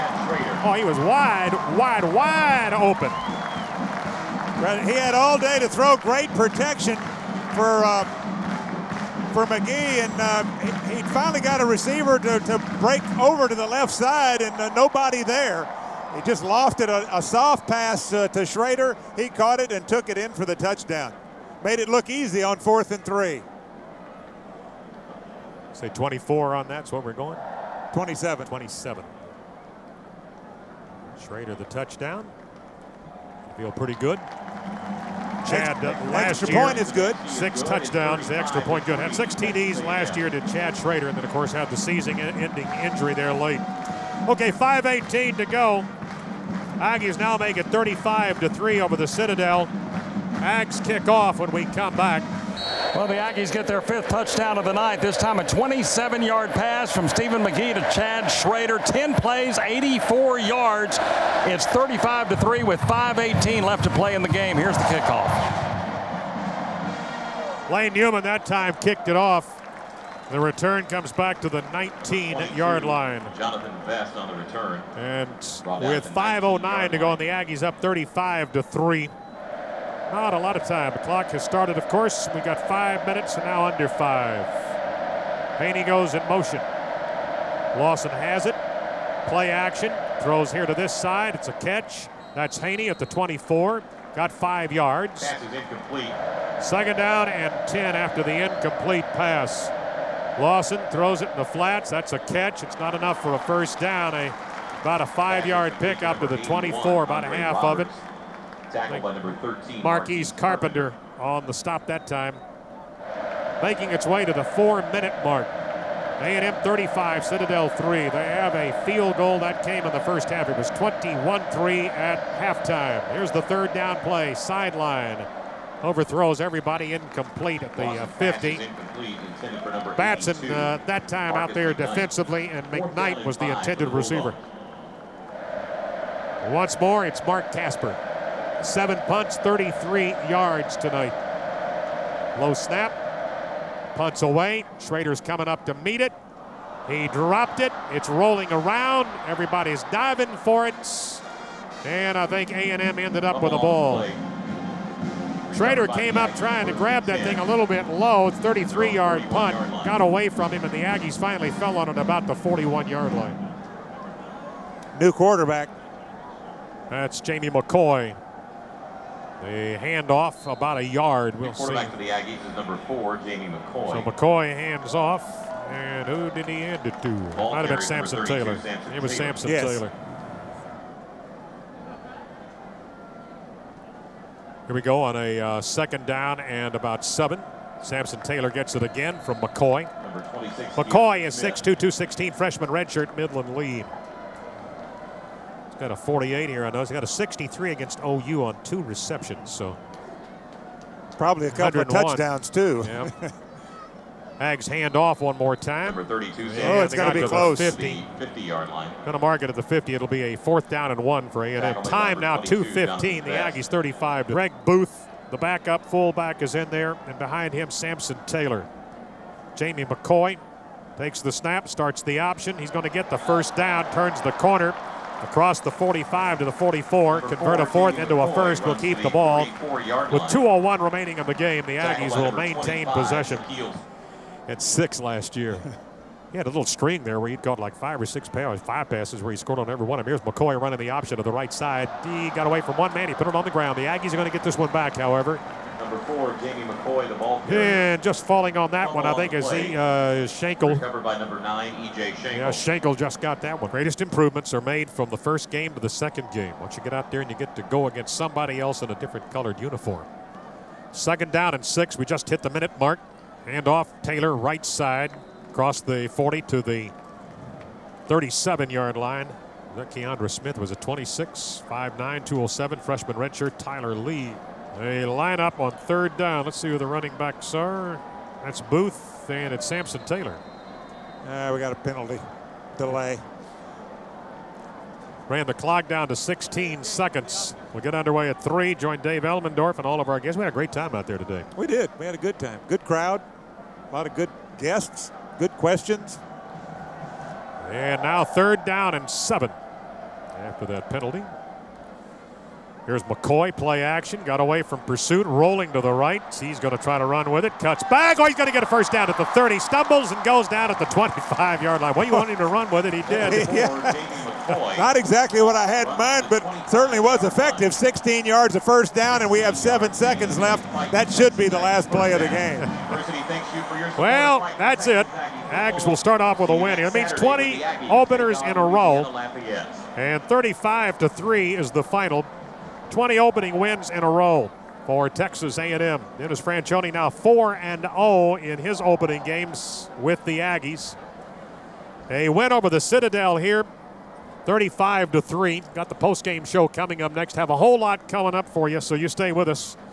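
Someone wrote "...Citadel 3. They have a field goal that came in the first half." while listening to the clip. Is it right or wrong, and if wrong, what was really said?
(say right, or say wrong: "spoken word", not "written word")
right.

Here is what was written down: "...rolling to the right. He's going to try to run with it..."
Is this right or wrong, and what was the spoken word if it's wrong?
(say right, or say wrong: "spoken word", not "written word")
right.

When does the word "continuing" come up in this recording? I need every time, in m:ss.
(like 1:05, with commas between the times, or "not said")
not said.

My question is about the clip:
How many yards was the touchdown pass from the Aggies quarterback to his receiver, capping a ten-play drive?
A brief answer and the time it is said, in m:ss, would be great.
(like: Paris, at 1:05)
27, at 0:55.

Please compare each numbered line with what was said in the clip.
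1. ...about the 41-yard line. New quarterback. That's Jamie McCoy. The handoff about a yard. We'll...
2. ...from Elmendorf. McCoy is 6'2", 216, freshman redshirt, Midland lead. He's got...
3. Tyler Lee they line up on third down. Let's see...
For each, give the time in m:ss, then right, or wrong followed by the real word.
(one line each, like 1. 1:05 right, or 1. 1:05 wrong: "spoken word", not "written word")
1. 2:41 right
2. 3:09 wrong: "McCoy", not "Elmendorf"
3. 4:33 right.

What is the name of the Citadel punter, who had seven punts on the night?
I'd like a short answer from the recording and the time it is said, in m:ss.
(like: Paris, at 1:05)
Mark Casper, at 2:17.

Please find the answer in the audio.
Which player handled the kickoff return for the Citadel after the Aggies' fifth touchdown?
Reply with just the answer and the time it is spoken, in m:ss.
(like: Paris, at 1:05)
Jonathan Vest, at 1:13.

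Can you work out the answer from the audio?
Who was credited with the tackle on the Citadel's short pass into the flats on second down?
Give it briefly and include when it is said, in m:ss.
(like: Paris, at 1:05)
Marquise Carpenter, at 1:49.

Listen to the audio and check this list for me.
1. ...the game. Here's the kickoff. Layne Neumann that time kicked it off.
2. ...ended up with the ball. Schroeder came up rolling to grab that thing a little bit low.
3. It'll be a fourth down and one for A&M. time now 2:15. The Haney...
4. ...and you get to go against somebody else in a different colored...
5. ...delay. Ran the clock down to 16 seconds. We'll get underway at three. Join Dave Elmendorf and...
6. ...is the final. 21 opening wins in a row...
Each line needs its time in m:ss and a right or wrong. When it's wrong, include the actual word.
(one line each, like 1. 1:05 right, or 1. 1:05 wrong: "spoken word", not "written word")
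1. 1:04 right
2. 2:32 wrong: "trying", not "rolling"
3. 3:29 wrong: "Aggies", not "Haney"
4. 4:17 right
5. 4:42 right
6. 5:31 wrong: "20", not "21".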